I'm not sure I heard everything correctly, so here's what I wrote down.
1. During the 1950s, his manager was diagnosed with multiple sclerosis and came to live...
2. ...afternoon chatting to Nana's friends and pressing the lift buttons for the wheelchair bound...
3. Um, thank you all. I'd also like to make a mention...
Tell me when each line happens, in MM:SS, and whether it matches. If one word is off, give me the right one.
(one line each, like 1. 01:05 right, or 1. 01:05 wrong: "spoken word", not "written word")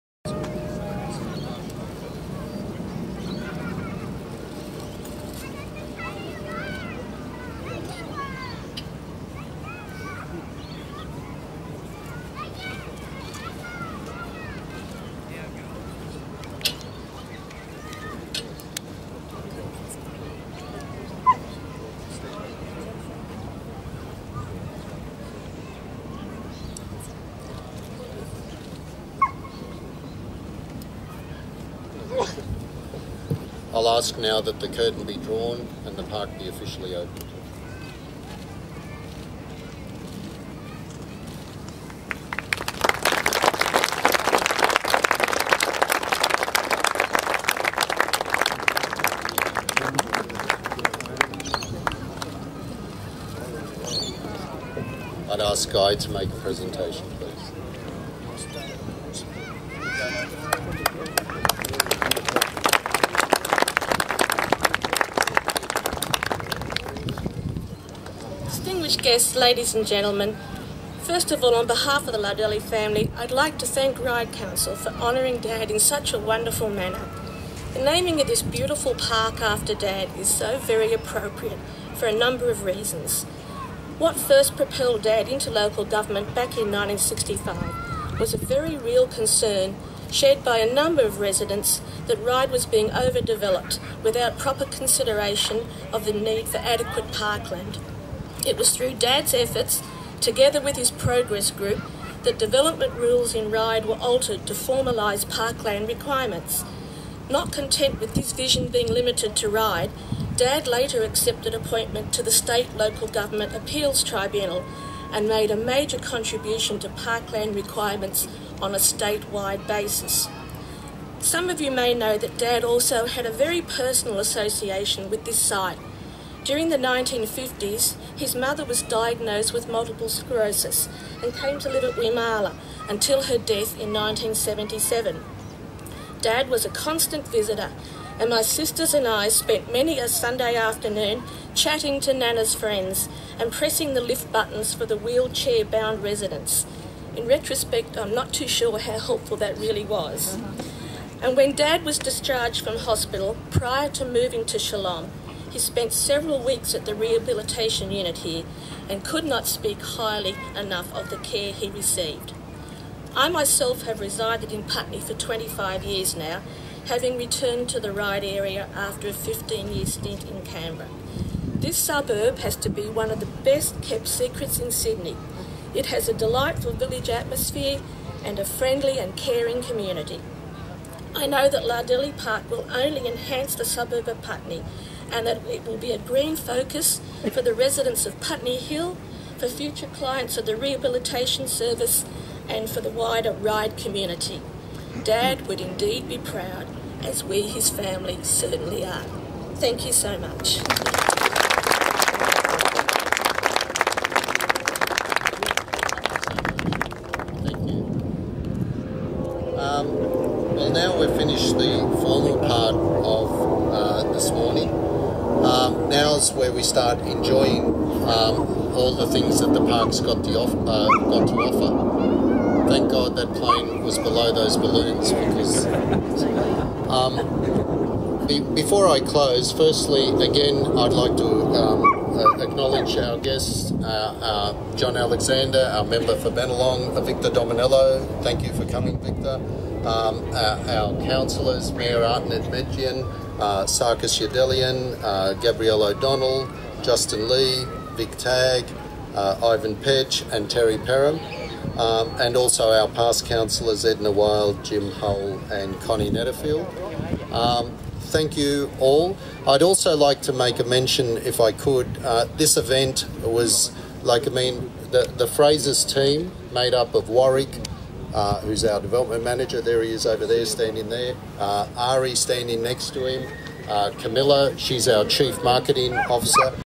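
1. 02:06 wrong: "mother", not "manager"
2. 02:20 right
3. 04:17 right.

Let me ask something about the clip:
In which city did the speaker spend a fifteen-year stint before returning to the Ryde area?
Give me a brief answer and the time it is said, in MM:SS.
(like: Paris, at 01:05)
Canberra, at 02:50.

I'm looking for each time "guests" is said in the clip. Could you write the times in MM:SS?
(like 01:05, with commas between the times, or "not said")
01:09, 03:53.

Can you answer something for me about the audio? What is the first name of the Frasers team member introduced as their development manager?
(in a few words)
Warwick.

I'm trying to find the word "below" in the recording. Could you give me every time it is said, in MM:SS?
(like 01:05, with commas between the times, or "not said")
03:43.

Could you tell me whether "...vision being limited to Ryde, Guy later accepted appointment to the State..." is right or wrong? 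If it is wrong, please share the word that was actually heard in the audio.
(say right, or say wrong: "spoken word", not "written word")
wrong: "Dad", not "Guy".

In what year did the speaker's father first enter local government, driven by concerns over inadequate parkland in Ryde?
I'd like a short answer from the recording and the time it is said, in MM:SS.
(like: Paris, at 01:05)
1965, at 01:26.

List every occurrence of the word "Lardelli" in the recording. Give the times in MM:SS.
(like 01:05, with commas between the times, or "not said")
01:12, 03:01.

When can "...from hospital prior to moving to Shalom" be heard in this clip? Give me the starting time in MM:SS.
02:32.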